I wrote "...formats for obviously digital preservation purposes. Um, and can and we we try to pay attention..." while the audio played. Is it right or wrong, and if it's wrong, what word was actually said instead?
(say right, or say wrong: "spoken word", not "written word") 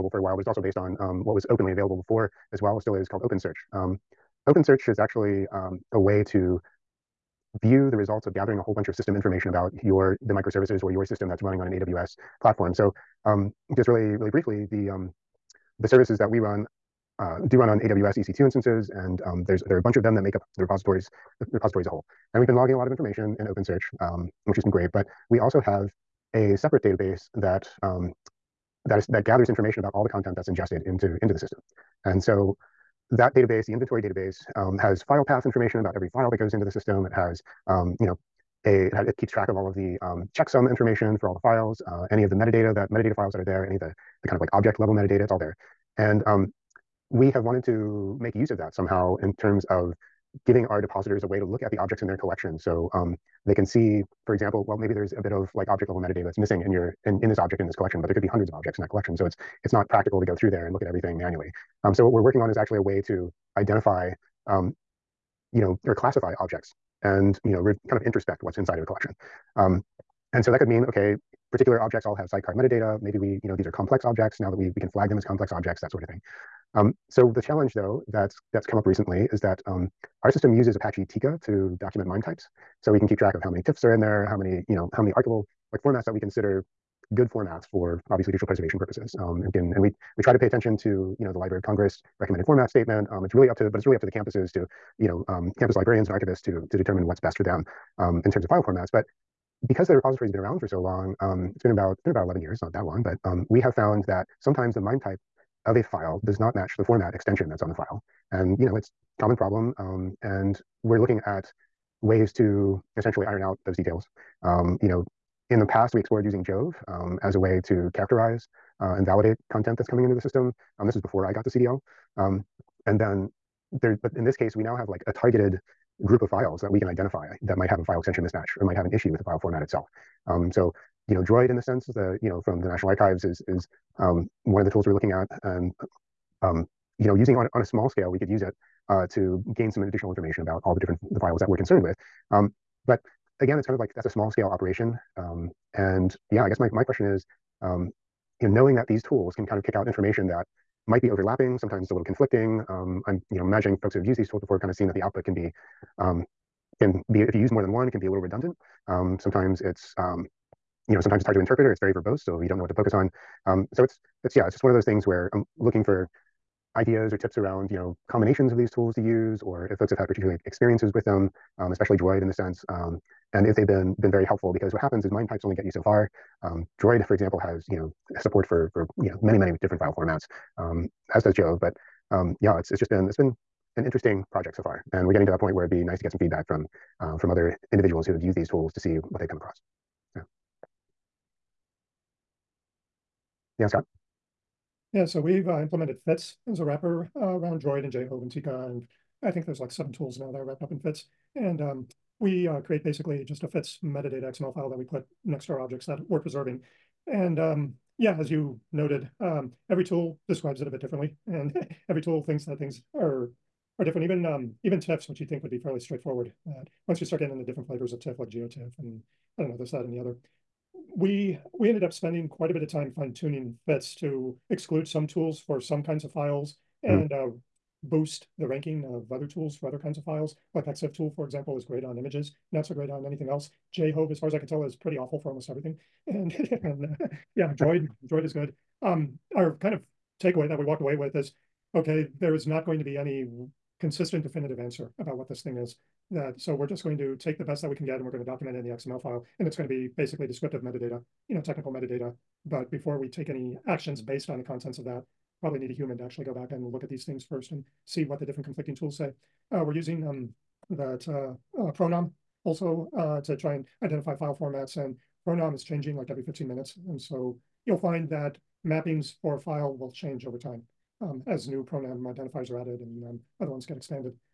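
right.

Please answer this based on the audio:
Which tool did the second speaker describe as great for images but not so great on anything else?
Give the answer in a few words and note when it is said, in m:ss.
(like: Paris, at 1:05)
ExifTool, at 3:50.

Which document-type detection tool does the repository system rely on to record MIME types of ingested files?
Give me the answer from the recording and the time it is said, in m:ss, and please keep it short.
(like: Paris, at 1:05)
Apache Tika, at 1:20.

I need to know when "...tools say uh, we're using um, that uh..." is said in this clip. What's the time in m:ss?
4:18.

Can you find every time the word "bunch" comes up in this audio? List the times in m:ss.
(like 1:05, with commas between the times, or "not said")
0:08, 0:19.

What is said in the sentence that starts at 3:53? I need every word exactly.
JHOVE, as far as I could tell, is pretty awful for almost everything.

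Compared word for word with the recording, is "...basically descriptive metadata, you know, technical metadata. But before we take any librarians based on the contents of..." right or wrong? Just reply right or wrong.
wrong.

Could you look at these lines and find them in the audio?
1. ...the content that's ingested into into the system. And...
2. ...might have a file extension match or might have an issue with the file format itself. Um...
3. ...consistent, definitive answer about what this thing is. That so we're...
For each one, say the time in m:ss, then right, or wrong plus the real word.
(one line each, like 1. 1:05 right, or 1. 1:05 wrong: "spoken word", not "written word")
1. 0:30 right
2. 2:07 wrong: "mismatch", not "match"
3. 4:03 right.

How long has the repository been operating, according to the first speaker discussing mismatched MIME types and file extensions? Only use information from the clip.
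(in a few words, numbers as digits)
11 years.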